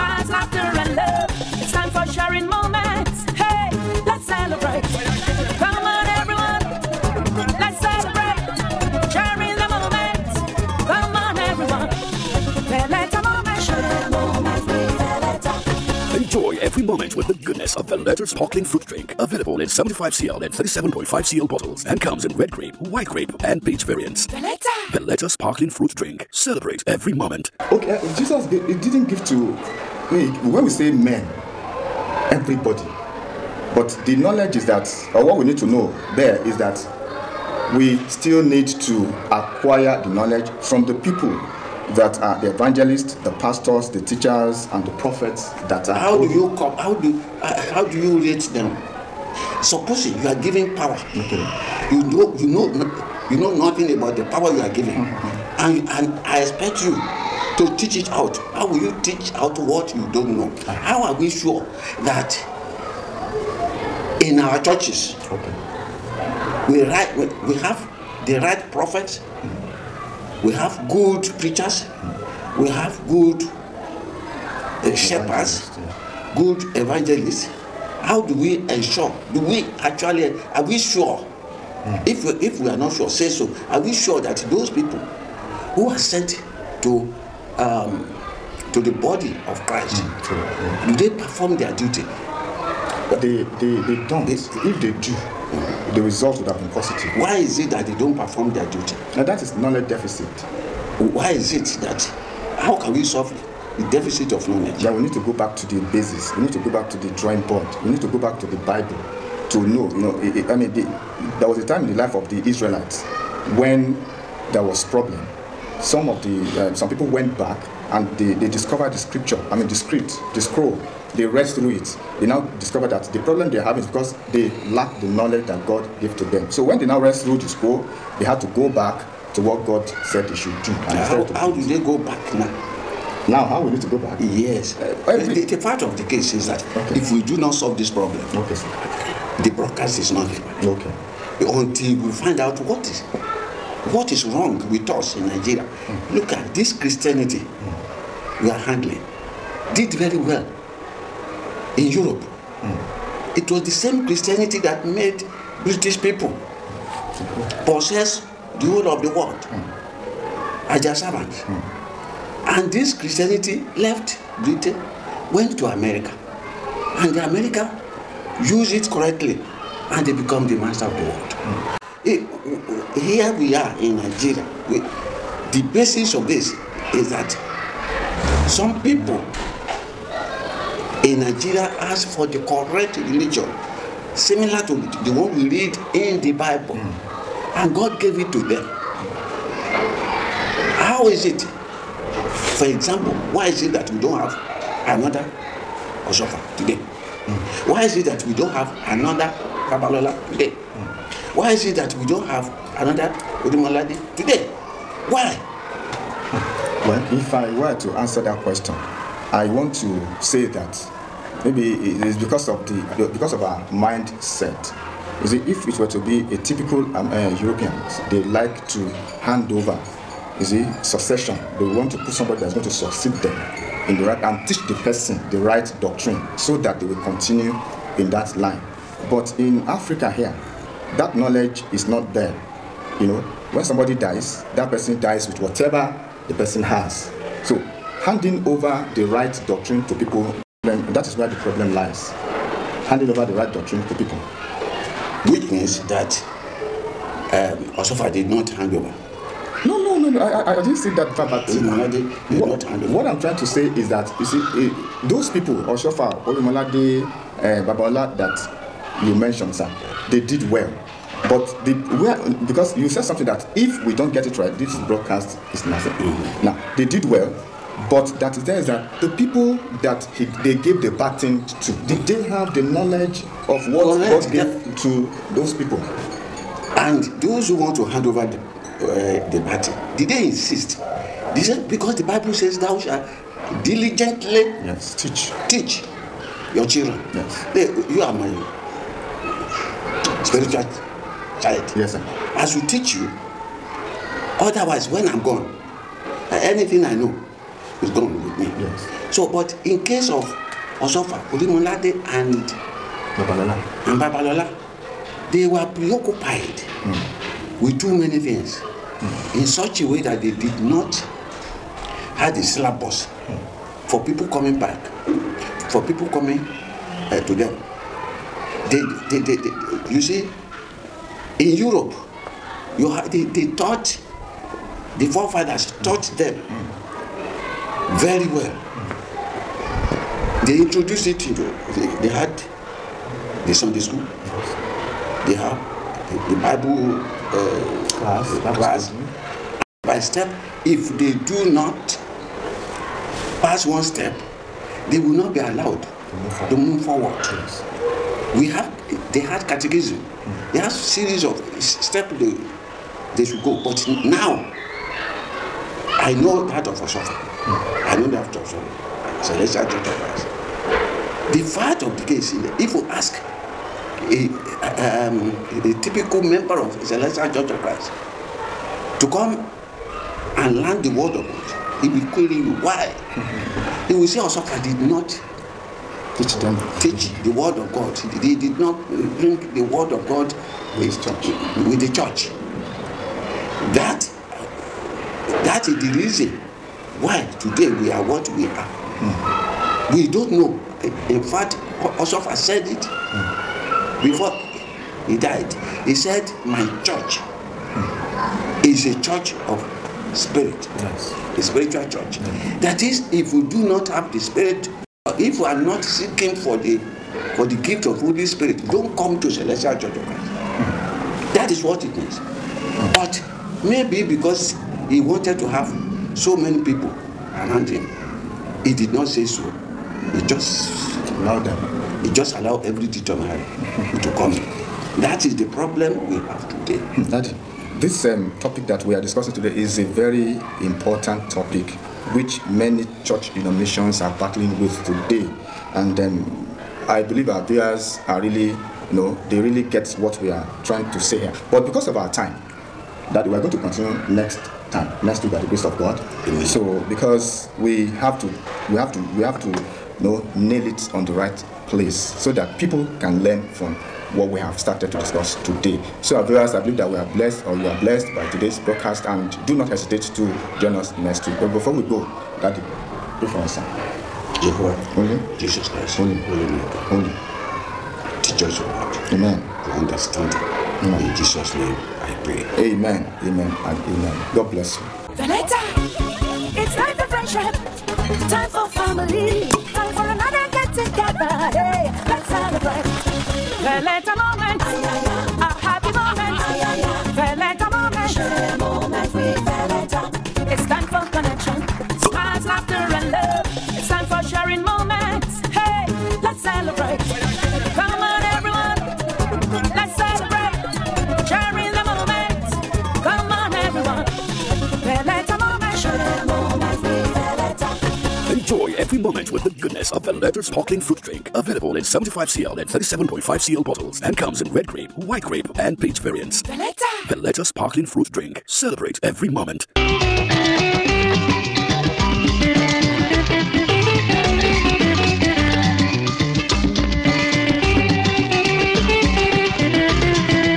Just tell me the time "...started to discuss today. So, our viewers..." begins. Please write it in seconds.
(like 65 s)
454 s.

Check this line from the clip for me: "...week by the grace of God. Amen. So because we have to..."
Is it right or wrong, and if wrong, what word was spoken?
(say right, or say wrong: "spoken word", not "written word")
right.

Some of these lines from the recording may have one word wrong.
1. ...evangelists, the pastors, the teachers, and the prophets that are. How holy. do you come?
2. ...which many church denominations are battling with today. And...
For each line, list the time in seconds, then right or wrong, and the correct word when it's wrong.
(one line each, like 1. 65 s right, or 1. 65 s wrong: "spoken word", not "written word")
1. 42 s right
2. 432 s right.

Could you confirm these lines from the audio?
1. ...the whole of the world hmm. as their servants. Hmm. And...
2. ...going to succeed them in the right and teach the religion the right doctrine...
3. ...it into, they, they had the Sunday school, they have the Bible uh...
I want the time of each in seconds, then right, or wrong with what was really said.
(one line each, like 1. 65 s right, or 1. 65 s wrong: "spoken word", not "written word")
1. 158 s right
2. 222 s wrong: "person", not "religion"
3. 331 s right.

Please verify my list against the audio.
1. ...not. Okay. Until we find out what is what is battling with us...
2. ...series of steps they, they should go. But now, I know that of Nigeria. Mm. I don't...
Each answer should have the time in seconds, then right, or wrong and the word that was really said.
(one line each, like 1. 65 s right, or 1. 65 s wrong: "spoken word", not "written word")
1. 140 s wrong: "wrong", not "battling"
2. 350 s wrong: "Oshofa", not "Nigeria".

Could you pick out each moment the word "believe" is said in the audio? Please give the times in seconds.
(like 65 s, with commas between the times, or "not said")
437 s, 456 s.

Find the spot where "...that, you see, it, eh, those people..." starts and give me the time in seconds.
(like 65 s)
253 s.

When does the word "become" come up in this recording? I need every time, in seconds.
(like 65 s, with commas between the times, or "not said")
170 s.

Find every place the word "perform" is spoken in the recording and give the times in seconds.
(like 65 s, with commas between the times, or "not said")
91 s, 98 s.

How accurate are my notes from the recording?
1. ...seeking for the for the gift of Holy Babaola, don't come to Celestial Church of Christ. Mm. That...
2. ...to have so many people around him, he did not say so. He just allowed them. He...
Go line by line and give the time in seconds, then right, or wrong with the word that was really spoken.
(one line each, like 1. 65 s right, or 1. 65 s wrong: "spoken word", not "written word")
1. 405 s wrong: "Spirit", not "Babaola"
2. 415 s right.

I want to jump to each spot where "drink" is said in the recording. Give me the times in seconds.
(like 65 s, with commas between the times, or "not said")
18 s, 25 s, 511 s, 518 s.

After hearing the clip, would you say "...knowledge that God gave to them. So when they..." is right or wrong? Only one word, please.
right.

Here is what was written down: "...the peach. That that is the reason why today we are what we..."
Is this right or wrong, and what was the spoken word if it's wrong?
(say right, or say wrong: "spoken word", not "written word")
wrong: "church", not "peach".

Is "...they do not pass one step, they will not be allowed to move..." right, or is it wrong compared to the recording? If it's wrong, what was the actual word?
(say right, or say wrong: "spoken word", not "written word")
right.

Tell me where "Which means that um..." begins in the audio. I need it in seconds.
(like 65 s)
245 s.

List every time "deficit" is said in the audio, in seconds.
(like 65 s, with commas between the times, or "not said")
99 s, 103 s.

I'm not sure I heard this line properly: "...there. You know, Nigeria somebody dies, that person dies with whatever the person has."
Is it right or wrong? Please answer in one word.
wrong.